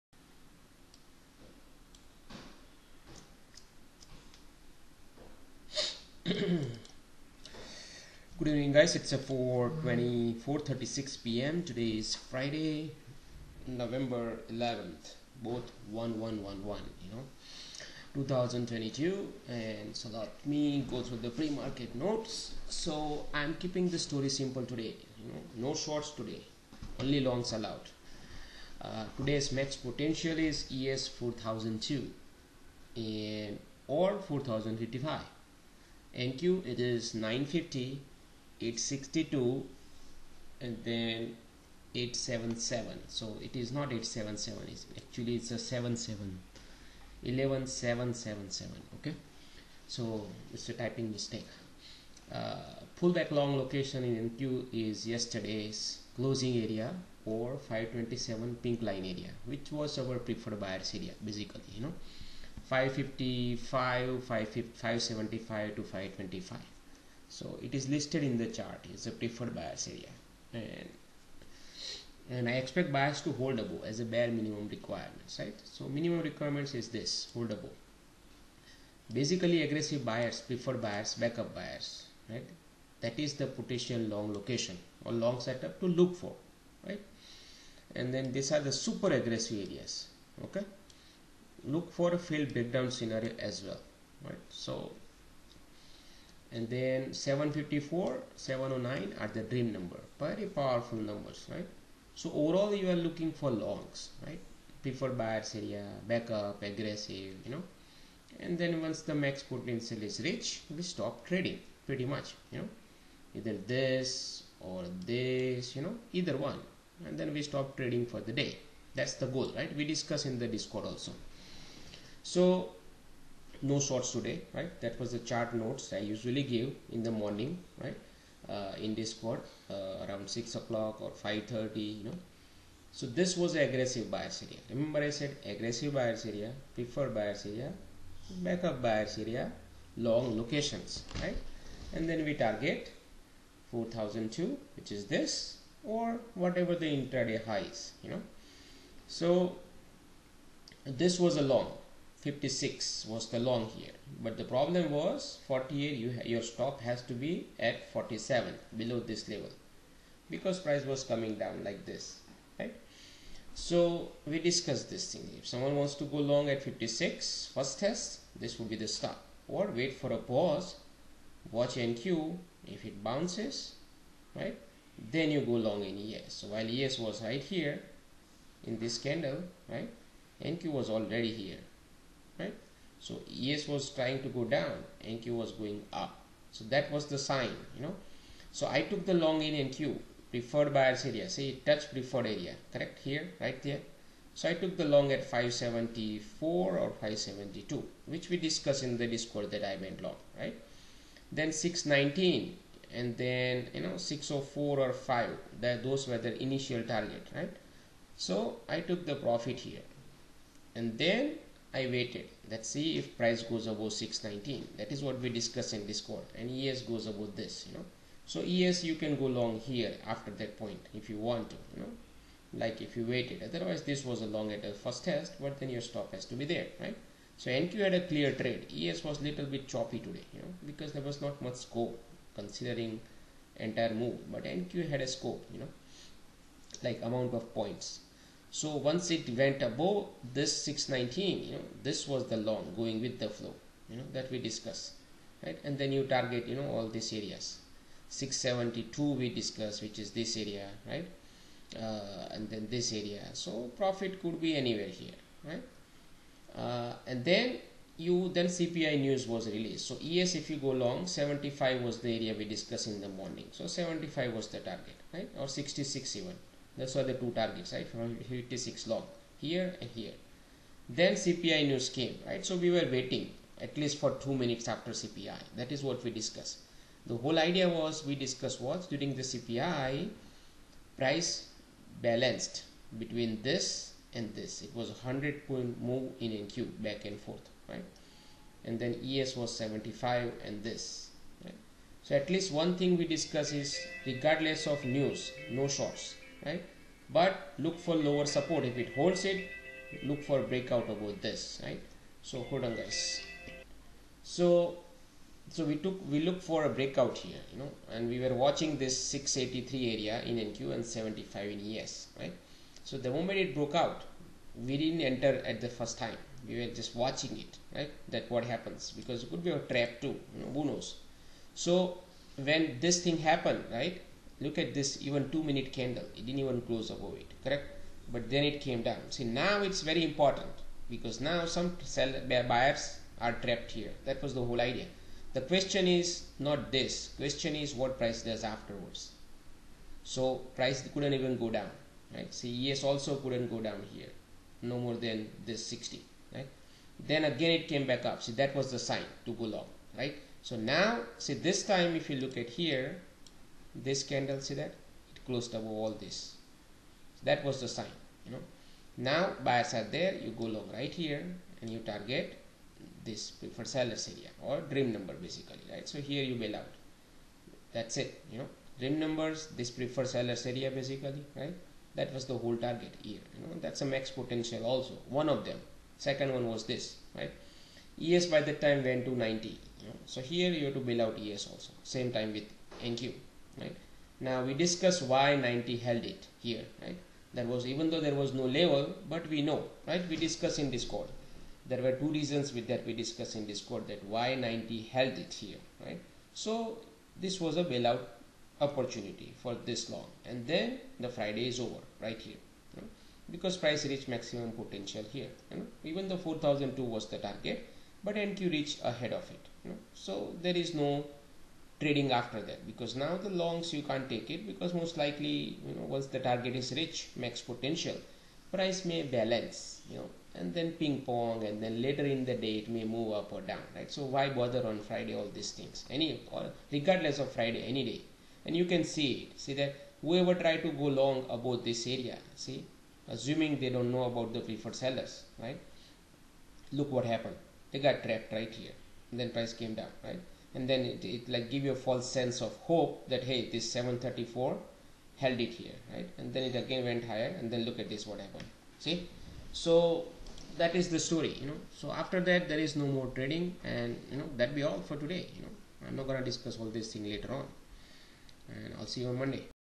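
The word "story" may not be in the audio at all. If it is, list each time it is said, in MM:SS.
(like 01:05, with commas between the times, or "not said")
00:23, 07:30.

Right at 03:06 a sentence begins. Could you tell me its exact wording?
So that was the sign, you know.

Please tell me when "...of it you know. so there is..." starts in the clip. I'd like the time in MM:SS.
06:49.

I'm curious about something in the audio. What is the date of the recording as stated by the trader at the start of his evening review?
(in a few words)
Friday, November 11th.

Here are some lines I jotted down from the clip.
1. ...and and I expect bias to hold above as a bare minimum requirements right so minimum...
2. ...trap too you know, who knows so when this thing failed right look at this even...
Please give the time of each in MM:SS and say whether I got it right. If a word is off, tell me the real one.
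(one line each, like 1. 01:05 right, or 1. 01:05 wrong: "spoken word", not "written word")
1. 01:10 right
2. 05:19 wrong: "happened", not "failed".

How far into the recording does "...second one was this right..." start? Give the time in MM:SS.
06:15.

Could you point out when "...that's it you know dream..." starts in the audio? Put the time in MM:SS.
06:07.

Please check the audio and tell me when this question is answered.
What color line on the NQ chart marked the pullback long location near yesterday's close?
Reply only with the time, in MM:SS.
00:58.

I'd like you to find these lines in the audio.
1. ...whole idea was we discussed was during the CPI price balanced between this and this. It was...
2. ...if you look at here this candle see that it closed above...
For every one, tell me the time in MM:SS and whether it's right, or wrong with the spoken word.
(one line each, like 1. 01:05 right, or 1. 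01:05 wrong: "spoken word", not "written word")
1. 04:37 right
2. 05:52 right.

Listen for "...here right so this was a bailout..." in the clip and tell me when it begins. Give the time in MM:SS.
06:35.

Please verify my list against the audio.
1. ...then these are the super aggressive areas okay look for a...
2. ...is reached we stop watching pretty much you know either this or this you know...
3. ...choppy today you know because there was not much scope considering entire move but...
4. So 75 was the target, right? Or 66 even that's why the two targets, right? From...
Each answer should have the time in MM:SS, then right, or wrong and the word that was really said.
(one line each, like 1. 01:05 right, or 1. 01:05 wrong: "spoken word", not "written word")
1. 01:28 right
2. 01:50 wrong: "trading", not "watching"
3. 03:49 right
4. 04:23 right.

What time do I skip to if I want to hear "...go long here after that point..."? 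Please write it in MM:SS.
03:39.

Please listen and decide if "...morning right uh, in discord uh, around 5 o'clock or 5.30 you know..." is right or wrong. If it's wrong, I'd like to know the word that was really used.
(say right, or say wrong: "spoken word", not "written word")
wrong: "6", not "5".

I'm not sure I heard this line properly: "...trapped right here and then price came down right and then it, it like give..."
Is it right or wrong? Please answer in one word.
right.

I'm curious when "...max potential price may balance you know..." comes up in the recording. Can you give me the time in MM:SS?
06:57.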